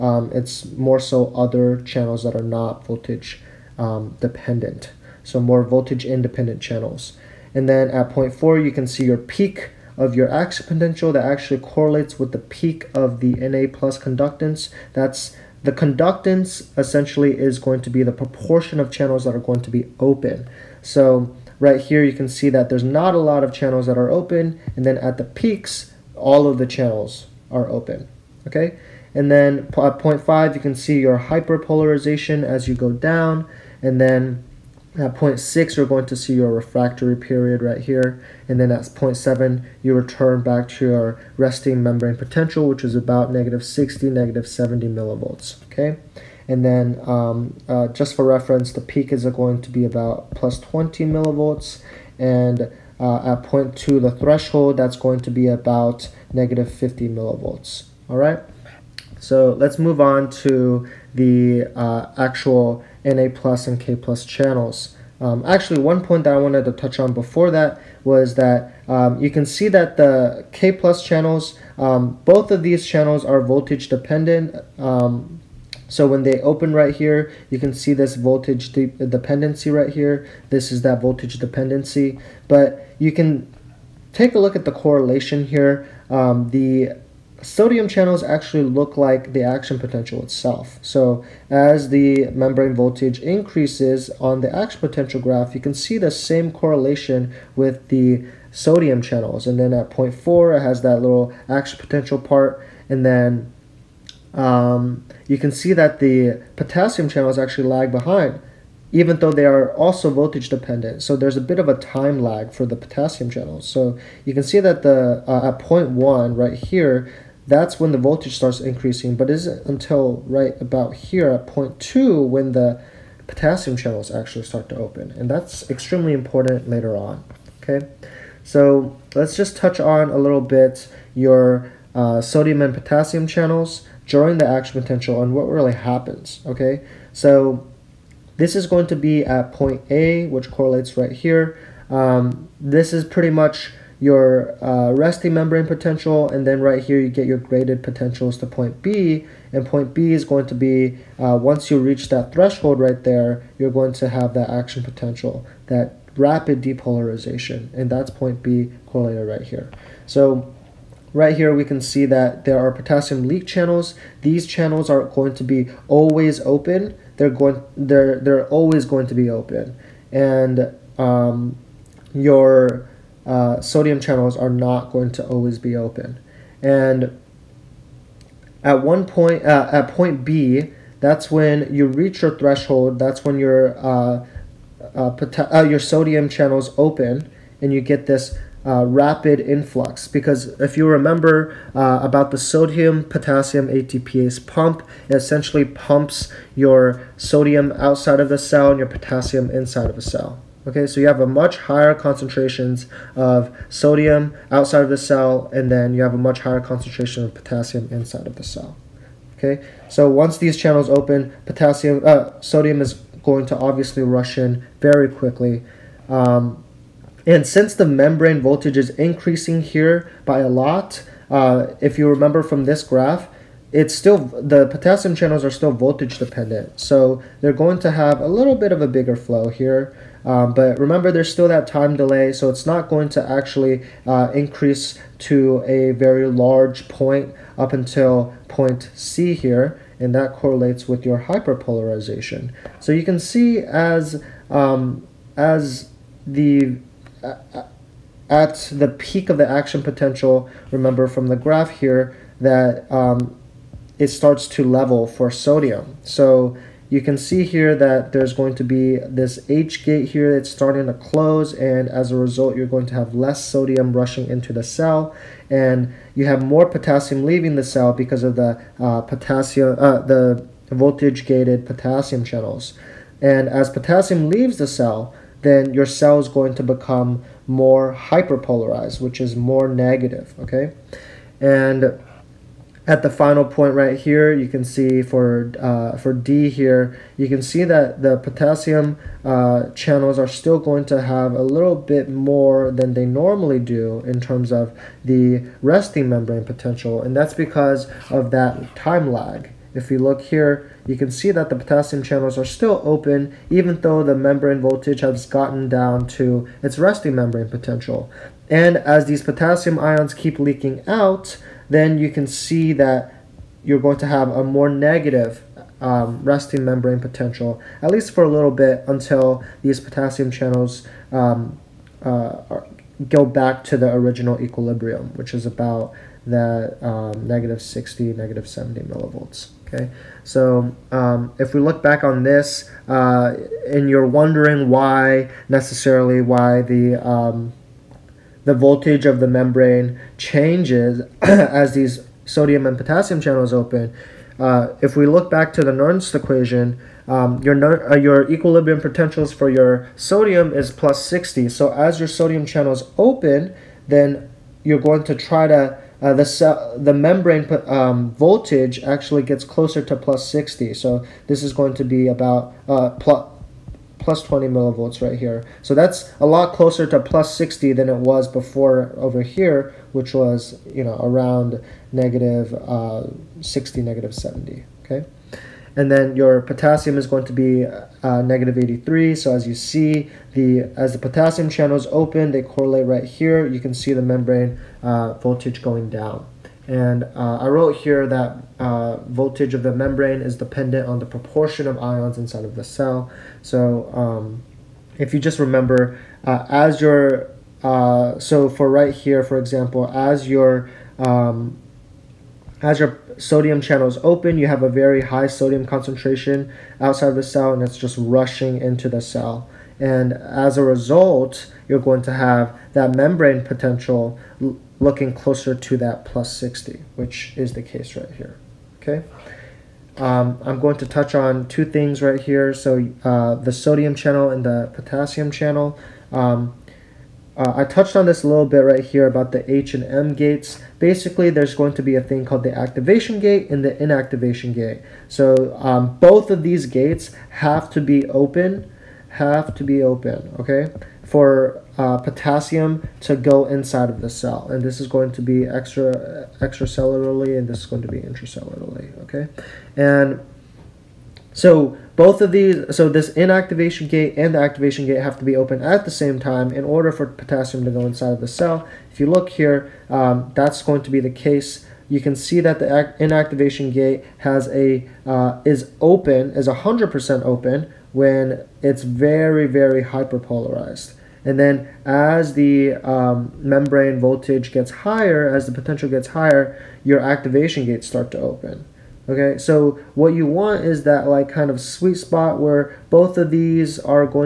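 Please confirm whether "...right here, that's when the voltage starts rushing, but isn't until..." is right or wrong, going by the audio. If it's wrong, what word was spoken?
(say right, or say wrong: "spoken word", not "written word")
wrong: "increasing", not "rushing".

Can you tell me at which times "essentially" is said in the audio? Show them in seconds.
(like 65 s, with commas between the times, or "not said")
16 s, 195 s.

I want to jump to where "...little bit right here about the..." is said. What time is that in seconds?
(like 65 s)
428 s.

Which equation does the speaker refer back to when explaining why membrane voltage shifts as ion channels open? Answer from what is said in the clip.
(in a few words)
Nernst equation.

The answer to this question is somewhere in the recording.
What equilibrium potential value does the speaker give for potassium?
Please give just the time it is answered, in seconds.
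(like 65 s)
378 s.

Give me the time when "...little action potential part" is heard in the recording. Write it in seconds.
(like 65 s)
101 s.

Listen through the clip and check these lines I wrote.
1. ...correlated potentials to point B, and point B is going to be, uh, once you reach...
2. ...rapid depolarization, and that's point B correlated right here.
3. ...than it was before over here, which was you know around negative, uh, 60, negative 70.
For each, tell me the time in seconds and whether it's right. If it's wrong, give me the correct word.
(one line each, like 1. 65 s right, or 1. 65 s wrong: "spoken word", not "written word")
1. 147 s wrong: "graded", not "correlated"
2. 156 s right
3. 367 s right.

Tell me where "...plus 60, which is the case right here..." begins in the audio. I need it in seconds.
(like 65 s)
416 s.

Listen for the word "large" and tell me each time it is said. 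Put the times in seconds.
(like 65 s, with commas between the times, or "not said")
236 s.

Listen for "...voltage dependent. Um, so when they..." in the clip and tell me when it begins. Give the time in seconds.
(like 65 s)
73 s.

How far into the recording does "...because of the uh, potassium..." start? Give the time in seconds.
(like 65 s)
267 s.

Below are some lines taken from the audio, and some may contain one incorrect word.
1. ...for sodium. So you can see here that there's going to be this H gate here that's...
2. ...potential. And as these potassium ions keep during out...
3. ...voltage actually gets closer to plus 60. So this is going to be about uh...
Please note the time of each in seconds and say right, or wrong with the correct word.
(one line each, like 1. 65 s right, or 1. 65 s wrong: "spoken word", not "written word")
1. 255 s right
2. 307 s wrong: "leaking", not "during"
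3. 358 s right.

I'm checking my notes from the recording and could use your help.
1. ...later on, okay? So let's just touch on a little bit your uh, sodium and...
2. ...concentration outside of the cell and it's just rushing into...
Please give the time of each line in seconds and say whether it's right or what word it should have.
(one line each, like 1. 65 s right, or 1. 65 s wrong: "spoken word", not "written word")
1. 126 s right
2. 405 s right.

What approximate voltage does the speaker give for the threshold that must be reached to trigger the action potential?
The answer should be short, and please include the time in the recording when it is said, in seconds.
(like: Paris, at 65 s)
-50 millivolts, at 56 s.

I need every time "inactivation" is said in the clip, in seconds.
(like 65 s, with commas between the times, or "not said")
433 s, 453 s, 462 s.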